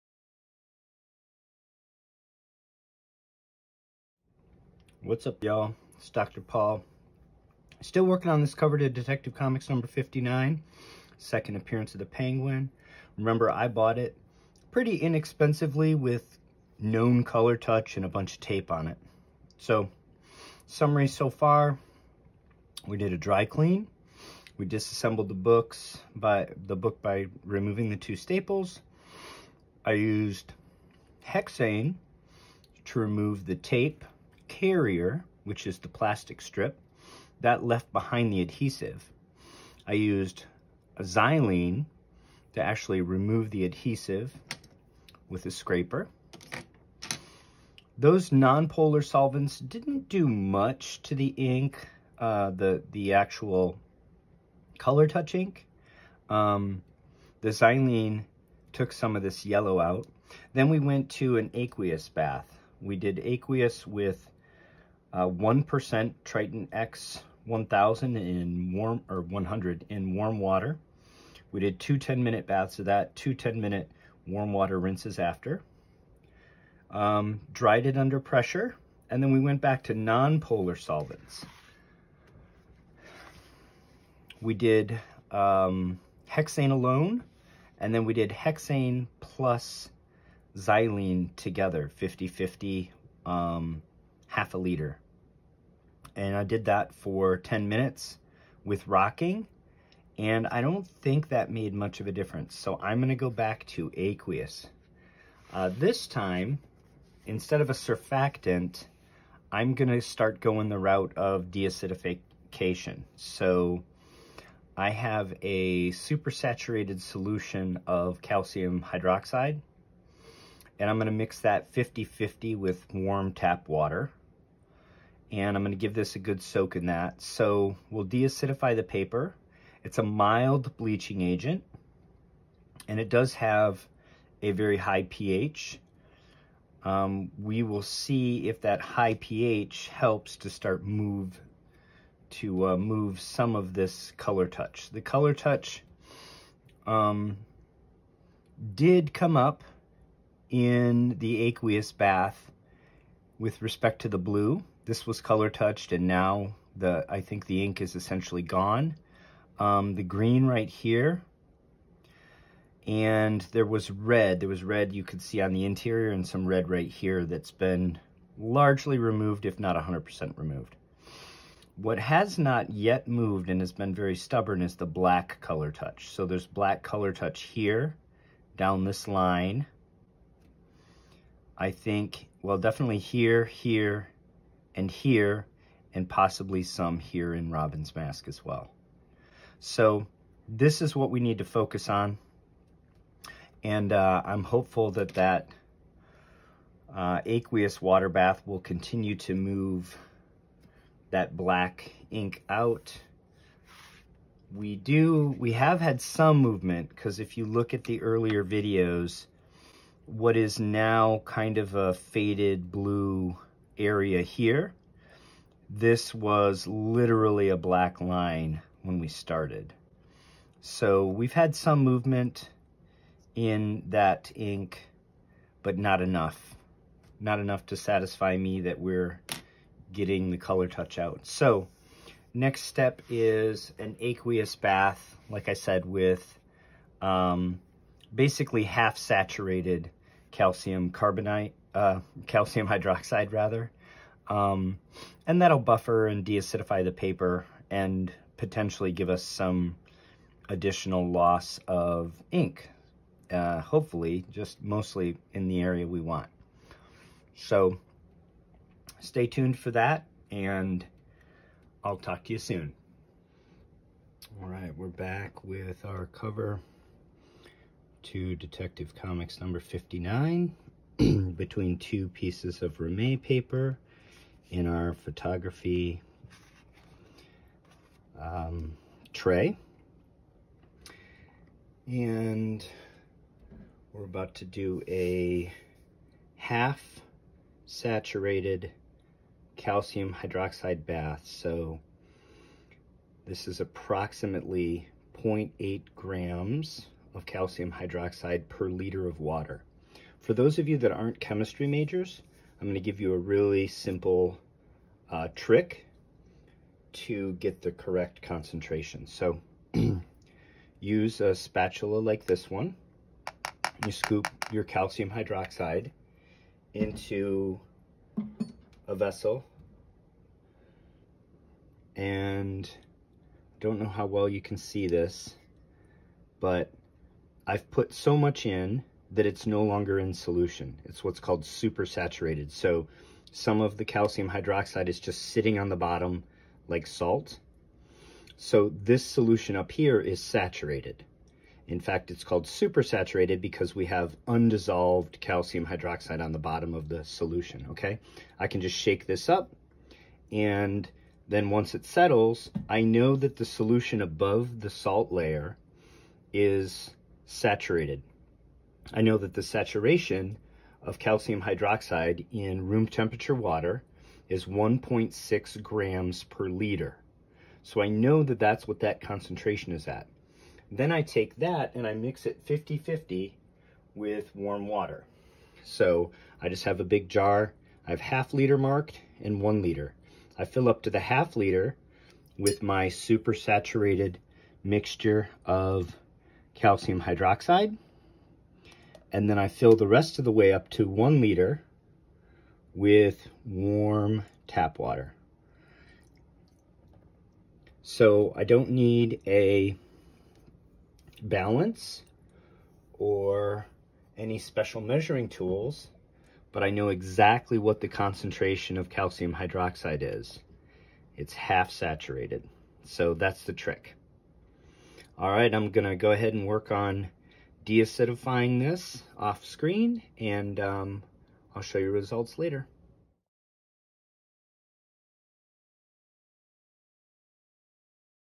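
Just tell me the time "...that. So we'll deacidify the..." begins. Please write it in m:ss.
2:06.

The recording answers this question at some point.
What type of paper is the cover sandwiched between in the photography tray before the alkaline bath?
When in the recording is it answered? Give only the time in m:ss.
4:32.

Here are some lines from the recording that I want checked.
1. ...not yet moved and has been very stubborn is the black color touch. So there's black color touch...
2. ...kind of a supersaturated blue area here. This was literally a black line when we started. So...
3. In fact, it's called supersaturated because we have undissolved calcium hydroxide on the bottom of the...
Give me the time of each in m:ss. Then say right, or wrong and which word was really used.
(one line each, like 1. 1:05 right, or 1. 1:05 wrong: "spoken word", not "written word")
1. 2:52 right
2. 3:31 wrong: "faded", not "supersaturated"
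3. 5:41 right.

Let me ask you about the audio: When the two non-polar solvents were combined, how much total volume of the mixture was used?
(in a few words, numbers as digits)
half a liter.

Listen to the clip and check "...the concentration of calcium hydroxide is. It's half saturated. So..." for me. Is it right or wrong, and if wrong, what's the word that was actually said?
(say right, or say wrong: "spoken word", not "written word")
right.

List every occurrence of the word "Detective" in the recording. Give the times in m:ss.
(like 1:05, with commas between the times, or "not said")
0:08, 4:28.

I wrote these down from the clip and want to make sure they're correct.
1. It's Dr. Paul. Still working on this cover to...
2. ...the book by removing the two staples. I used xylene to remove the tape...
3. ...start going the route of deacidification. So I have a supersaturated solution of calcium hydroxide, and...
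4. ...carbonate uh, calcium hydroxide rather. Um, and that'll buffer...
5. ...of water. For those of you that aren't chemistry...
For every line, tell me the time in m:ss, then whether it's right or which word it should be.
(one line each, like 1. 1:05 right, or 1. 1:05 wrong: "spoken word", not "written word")
1. 0:05 right
2. 0:26 wrong: "hexane", not "xylene"
3. 1:50 right
4. 4:00 right
5. 4:59 right.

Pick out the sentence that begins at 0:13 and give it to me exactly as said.
Remember, I bought it pretty inexpensively with known color touch and a bunch of tape on it.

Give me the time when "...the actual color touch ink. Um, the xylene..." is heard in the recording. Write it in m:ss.
0:52.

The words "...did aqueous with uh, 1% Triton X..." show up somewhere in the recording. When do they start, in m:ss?
1:02.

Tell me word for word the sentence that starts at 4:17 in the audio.
So stay tuned for that and I'll talk to you soon.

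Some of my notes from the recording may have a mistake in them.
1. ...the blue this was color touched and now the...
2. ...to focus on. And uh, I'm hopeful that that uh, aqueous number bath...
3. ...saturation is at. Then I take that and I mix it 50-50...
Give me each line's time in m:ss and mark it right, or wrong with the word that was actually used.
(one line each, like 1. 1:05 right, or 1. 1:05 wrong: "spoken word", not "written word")
1. 2:34 right
2. 3:11 wrong: "water", not "number"
3. 6:08 wrong: "concentration", not "saturation".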